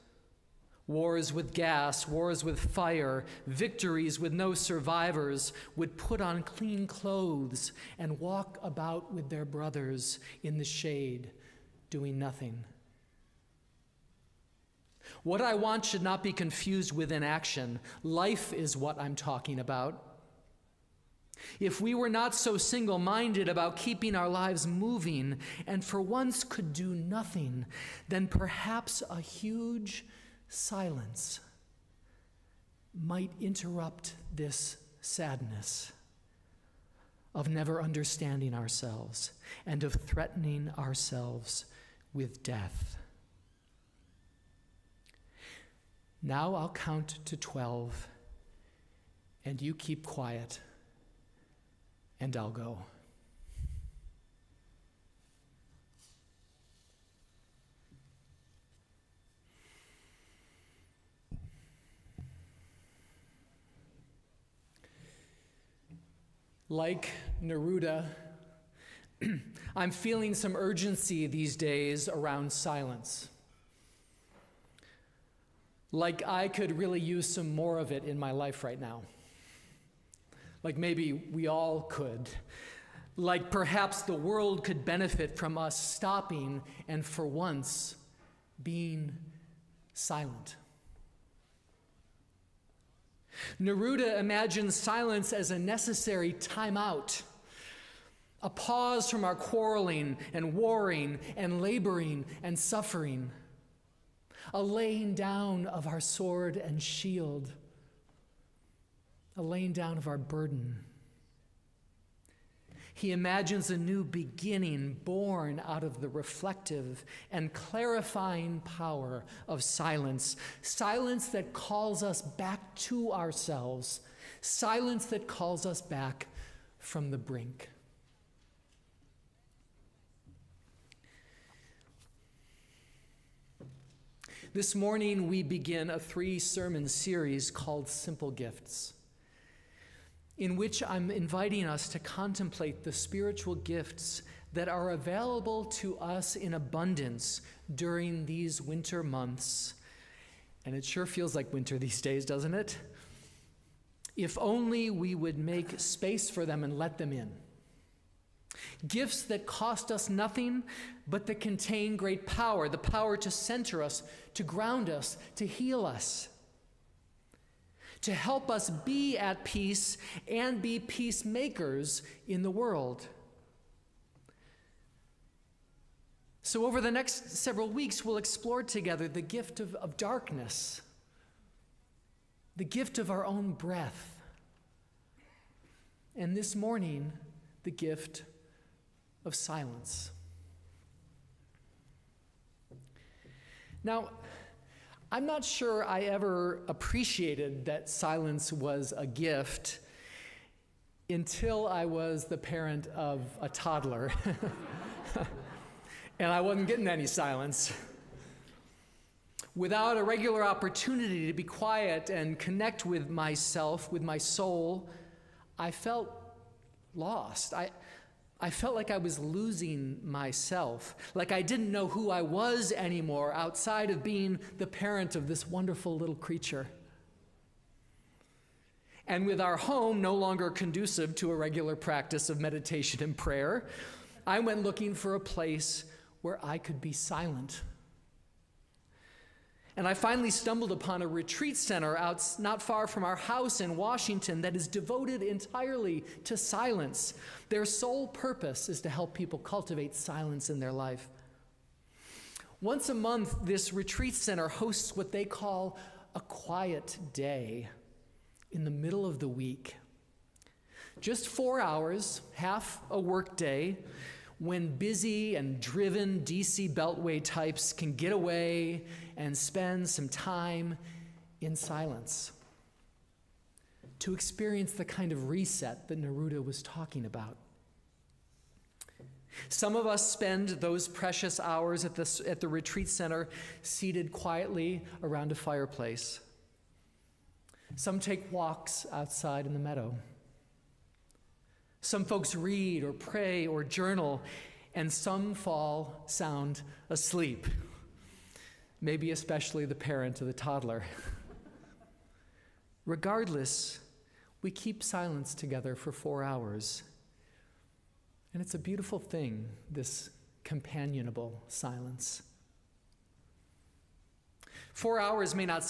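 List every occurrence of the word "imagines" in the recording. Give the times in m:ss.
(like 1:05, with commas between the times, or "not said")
1:34, 1:53.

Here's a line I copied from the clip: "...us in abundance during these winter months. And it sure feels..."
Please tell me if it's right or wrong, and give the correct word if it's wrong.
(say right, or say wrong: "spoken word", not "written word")
right.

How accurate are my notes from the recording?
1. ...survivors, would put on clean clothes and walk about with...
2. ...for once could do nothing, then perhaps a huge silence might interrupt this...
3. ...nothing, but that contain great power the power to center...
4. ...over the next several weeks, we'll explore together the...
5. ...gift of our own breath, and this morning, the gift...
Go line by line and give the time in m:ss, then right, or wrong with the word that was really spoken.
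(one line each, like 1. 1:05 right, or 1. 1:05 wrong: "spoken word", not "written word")
1. 0:04 right
2. 0:25 right
3. 2:40 right
4. 2:56 right
5. 3:02 right.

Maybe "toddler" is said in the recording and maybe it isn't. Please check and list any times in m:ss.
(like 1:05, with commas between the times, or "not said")
3:23, 5:00.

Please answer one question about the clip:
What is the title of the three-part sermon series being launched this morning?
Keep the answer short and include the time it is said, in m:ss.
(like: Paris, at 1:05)
Simple Gifts, at 2:17.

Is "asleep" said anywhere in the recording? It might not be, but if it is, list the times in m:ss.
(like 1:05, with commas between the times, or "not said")
4:56.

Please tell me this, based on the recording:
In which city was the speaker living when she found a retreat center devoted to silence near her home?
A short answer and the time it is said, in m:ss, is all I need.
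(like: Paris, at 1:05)
Washington, at 4:03.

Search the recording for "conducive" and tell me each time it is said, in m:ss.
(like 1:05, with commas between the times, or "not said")
3:50.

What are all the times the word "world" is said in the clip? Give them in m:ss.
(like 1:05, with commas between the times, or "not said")
1:24, 2:52.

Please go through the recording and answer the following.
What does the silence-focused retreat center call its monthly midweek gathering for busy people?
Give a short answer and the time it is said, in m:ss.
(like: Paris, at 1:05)
quiet day, at 4:16.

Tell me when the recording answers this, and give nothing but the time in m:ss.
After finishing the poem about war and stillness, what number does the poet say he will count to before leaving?
0:47.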